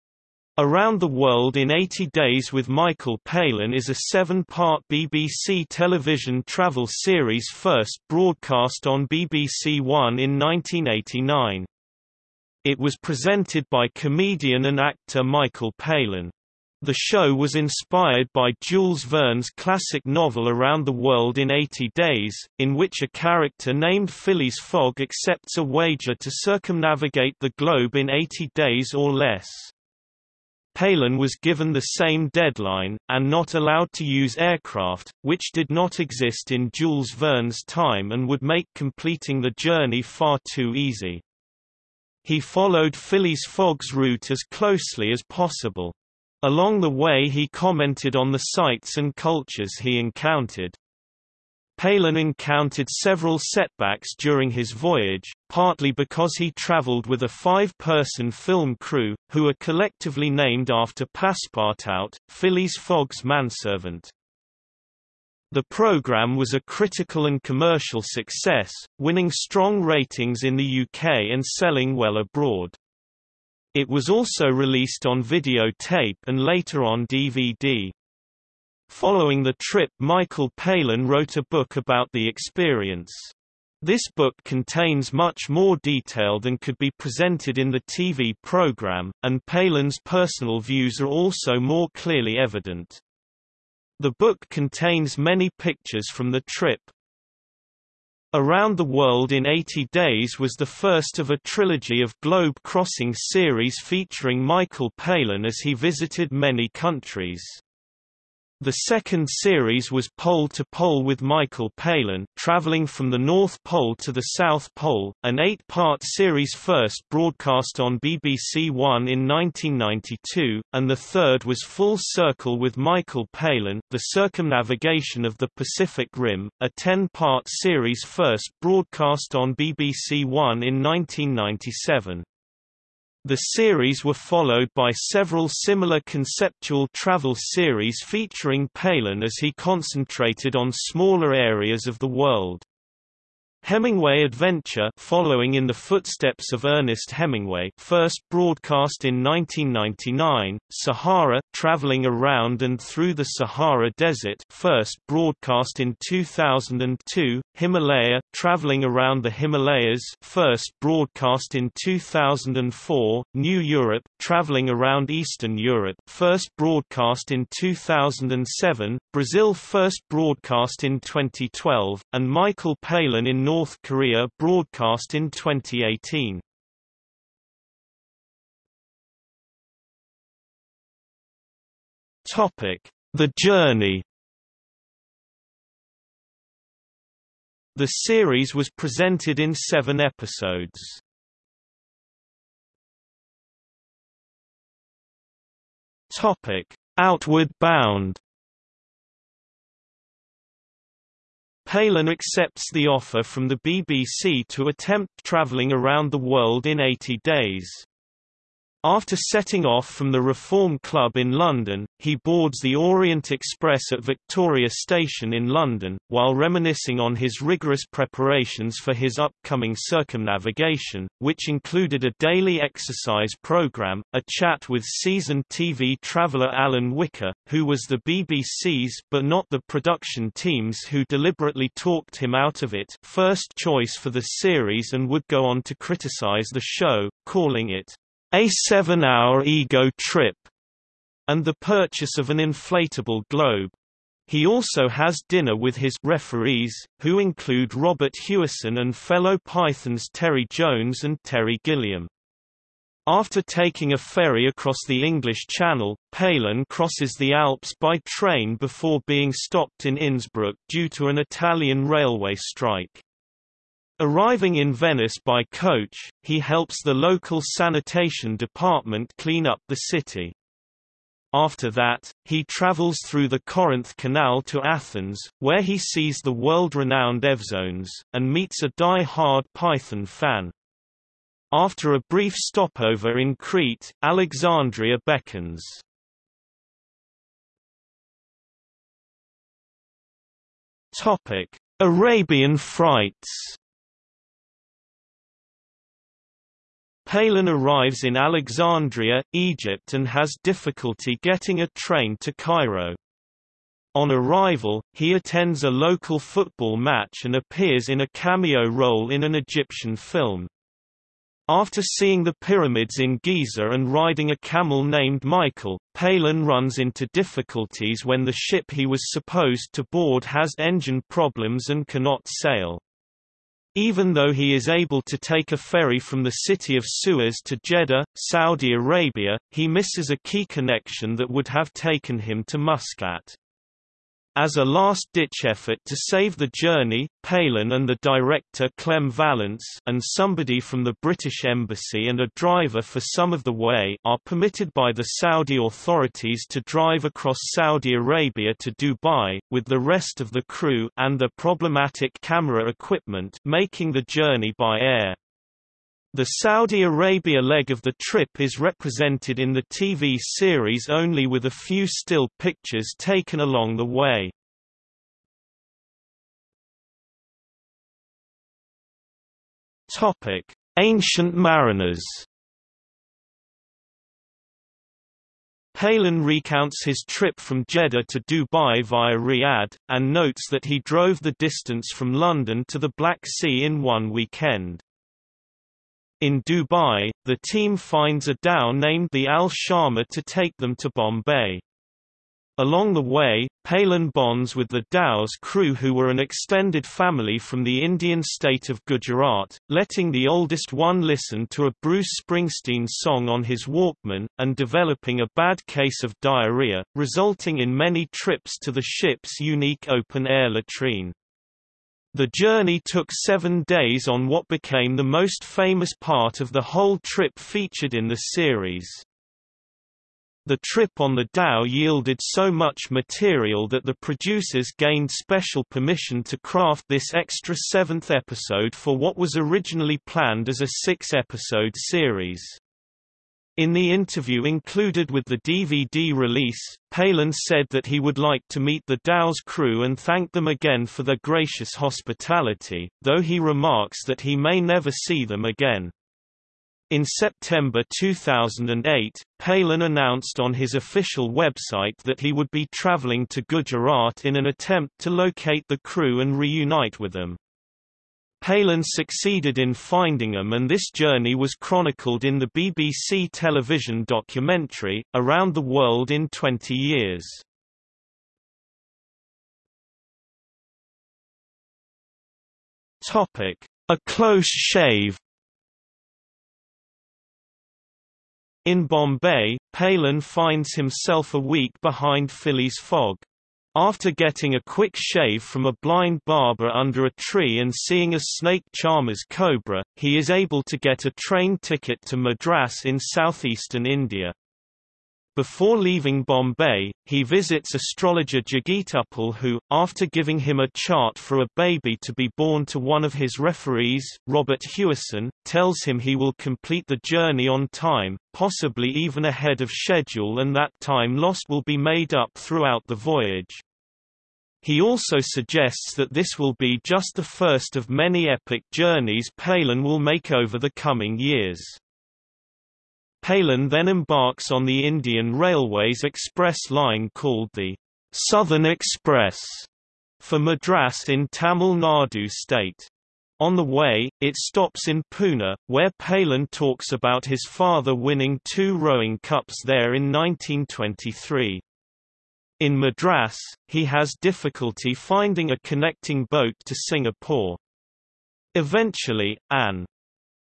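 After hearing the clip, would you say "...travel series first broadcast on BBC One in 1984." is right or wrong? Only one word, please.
wrong.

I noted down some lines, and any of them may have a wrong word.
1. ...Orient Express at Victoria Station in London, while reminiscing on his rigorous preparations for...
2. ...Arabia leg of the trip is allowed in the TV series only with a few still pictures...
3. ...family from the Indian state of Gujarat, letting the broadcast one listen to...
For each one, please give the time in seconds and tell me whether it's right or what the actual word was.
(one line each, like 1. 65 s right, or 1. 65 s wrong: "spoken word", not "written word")
1. 212 s right
2. 356 s wrong: "represented", not "allowed"
3. 396 s wrong: "oldest", not "broadcast".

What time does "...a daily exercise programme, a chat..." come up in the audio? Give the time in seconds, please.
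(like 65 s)
222 s.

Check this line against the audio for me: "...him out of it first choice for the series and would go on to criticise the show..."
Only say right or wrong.
right.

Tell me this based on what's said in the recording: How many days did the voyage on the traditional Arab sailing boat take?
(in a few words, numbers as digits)
7.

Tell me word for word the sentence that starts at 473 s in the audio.
A close shave In Bombay, Palin finds himself a week behind Phileas Fogg.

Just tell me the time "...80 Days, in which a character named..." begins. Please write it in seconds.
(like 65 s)
21 s.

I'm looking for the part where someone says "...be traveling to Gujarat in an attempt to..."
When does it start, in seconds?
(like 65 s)
452 s.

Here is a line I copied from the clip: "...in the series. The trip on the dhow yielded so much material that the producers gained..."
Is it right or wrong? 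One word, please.
right.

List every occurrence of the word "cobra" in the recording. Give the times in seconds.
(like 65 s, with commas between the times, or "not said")
489 s.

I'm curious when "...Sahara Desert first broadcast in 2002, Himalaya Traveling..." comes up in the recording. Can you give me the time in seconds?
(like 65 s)
153 s.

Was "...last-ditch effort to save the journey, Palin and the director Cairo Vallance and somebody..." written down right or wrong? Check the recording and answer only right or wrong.
wrong.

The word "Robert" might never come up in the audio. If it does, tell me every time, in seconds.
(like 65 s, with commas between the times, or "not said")
247 s, 504 s.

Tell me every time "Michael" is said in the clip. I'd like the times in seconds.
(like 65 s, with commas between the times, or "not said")
2 s, 15 s, 79 s, 104 s, 111 s, 122 s, 172 s, 315 s.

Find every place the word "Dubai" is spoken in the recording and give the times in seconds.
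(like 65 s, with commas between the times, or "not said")
348 s, 378 s, 386 s.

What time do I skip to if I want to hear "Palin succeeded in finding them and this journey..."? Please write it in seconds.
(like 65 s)
458 s.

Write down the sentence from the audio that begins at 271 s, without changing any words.
After that, he travels through the Corinth Canal to Athens, where he sees the world-renowned Evzones, and meets a die-hard Python fan.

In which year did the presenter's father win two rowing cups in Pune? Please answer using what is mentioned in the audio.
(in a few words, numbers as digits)
1923.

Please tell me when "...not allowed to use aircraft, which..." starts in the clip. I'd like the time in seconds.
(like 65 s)
33 s.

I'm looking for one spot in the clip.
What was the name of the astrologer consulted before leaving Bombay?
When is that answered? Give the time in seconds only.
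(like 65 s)
498 s.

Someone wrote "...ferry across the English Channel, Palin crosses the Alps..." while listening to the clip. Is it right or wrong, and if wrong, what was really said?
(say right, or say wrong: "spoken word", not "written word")
right.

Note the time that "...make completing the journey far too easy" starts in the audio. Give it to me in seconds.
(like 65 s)
38 s.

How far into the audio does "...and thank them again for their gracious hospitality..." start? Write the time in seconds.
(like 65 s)
439 s.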